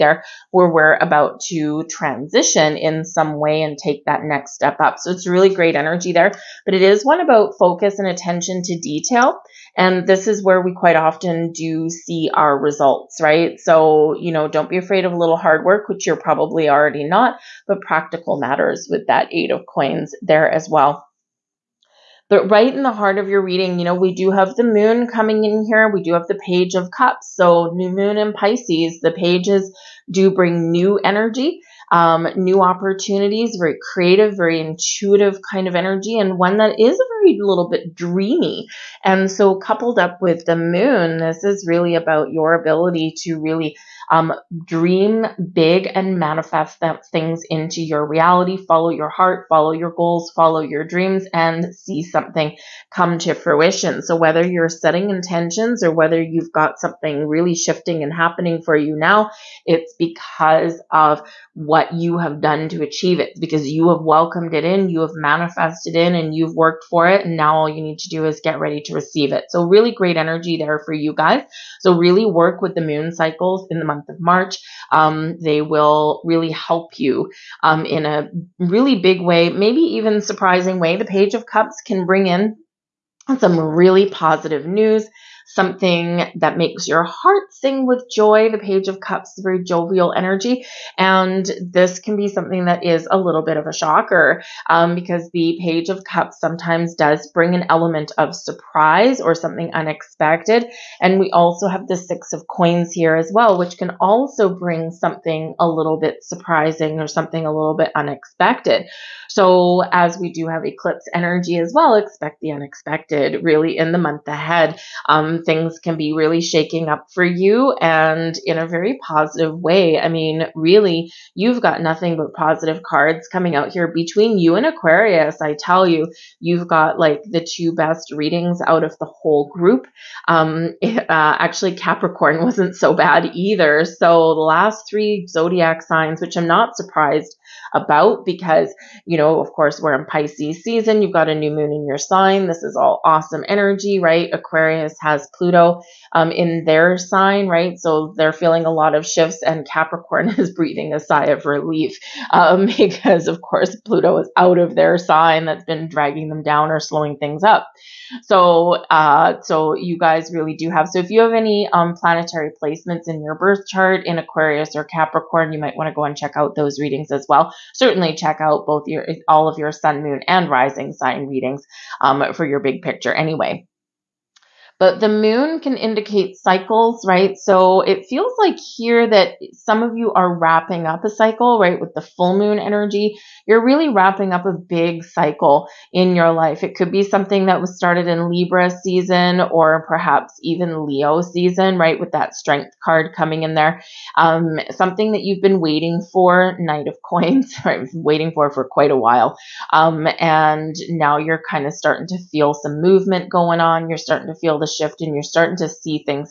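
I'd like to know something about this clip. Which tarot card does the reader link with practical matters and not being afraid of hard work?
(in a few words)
Eight of Coins.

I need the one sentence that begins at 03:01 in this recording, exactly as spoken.
With the full moon energy, you're really wrapping up a big cycle in your life.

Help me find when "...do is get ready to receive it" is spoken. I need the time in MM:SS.
01:08.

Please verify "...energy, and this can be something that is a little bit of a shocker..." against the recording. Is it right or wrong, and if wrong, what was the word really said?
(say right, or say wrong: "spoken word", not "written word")
right.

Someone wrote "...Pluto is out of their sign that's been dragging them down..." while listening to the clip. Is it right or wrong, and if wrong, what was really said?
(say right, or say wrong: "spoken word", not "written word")
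right.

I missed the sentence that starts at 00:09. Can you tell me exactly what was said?
And this is where we quite often do see our results, right?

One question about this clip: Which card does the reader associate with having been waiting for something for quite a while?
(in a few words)
Knight of Coins.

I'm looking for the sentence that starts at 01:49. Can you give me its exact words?
So, as we do have eclipse energy as well, expect the unexpected really in the month ahead.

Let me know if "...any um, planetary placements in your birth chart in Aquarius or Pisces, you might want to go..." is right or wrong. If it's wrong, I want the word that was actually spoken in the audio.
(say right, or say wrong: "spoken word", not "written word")
wrong: "Capricorn", not "Pisces".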